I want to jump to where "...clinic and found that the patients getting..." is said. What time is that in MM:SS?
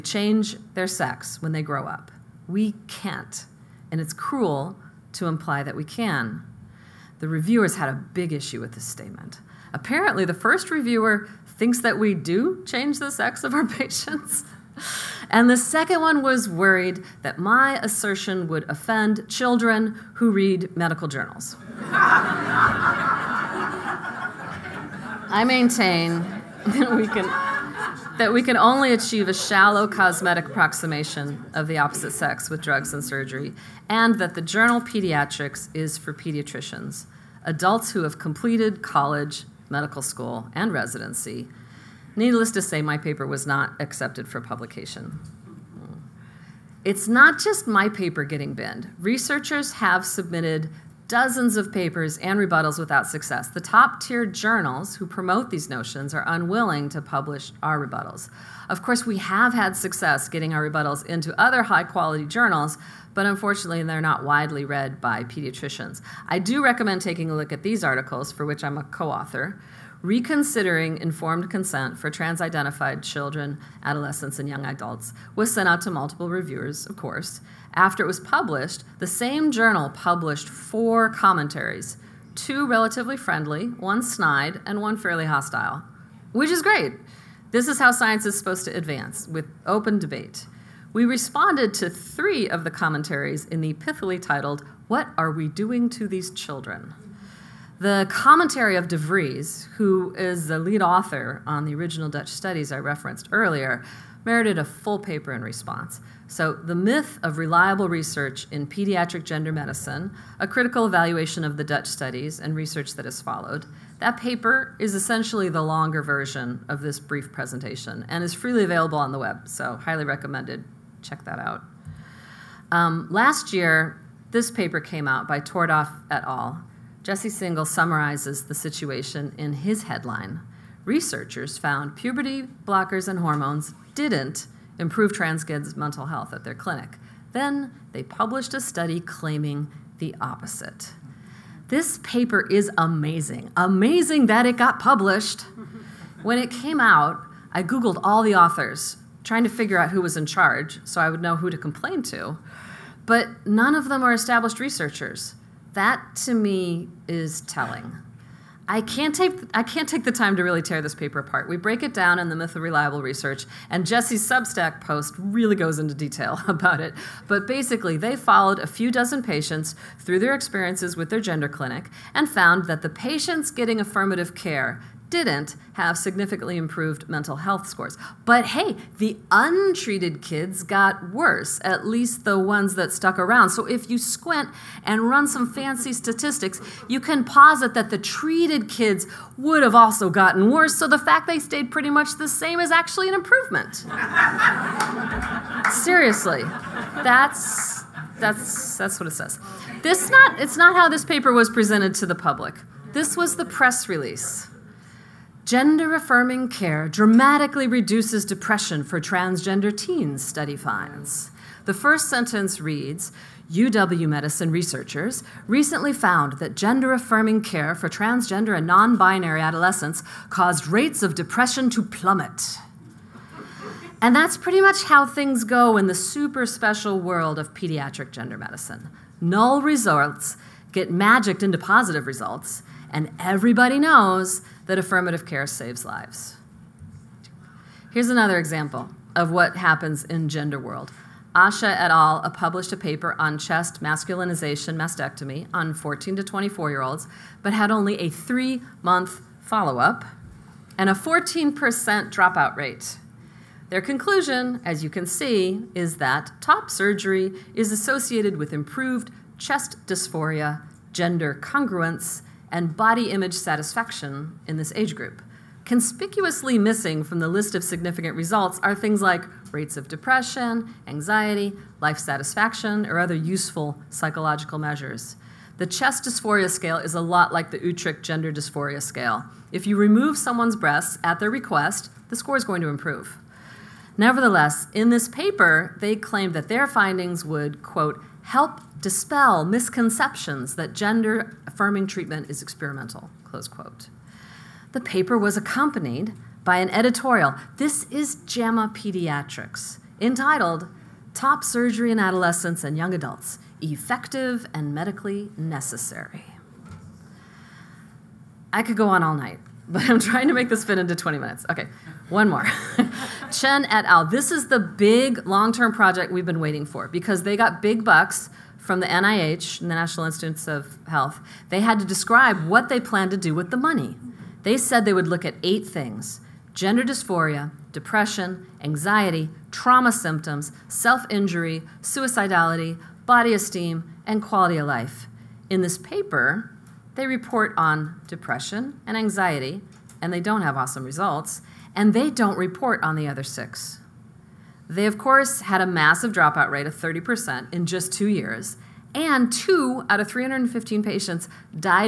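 02:51.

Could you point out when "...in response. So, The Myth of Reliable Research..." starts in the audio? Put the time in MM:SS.
01:45.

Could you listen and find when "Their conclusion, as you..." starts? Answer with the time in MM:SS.
04:13.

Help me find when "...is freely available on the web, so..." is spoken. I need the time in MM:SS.
01:58.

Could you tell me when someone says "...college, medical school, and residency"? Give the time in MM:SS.
00:38.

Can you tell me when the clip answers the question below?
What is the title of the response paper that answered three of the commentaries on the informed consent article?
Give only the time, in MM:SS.
01:34.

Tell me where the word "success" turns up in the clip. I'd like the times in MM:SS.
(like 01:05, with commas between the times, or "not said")
00:53, 00:59.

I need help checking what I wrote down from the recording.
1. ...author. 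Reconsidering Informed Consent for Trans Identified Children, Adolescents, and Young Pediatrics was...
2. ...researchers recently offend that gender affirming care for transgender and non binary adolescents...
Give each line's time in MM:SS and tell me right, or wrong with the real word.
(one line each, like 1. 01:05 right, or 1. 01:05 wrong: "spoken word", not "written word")
1. 01:09 wrong: "Adults", not "Pediatrics"
2. 03:34 wrong: "found", not "offend".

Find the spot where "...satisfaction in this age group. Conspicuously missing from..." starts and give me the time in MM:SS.
04:23.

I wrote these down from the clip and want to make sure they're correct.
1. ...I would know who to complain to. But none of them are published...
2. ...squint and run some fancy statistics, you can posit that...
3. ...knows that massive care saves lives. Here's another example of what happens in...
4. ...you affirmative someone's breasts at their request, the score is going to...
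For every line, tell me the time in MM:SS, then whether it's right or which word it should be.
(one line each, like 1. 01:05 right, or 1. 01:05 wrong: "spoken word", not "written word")
1. 02:31 wrong: "established", not "published"
2. 03:03 right
3. 03:53 wrong: "affirmative", not "massive"
4. 04:39 wrong: "remove", not "affirmative".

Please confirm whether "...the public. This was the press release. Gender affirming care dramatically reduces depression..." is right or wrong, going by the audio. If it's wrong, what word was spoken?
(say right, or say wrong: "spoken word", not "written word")
right.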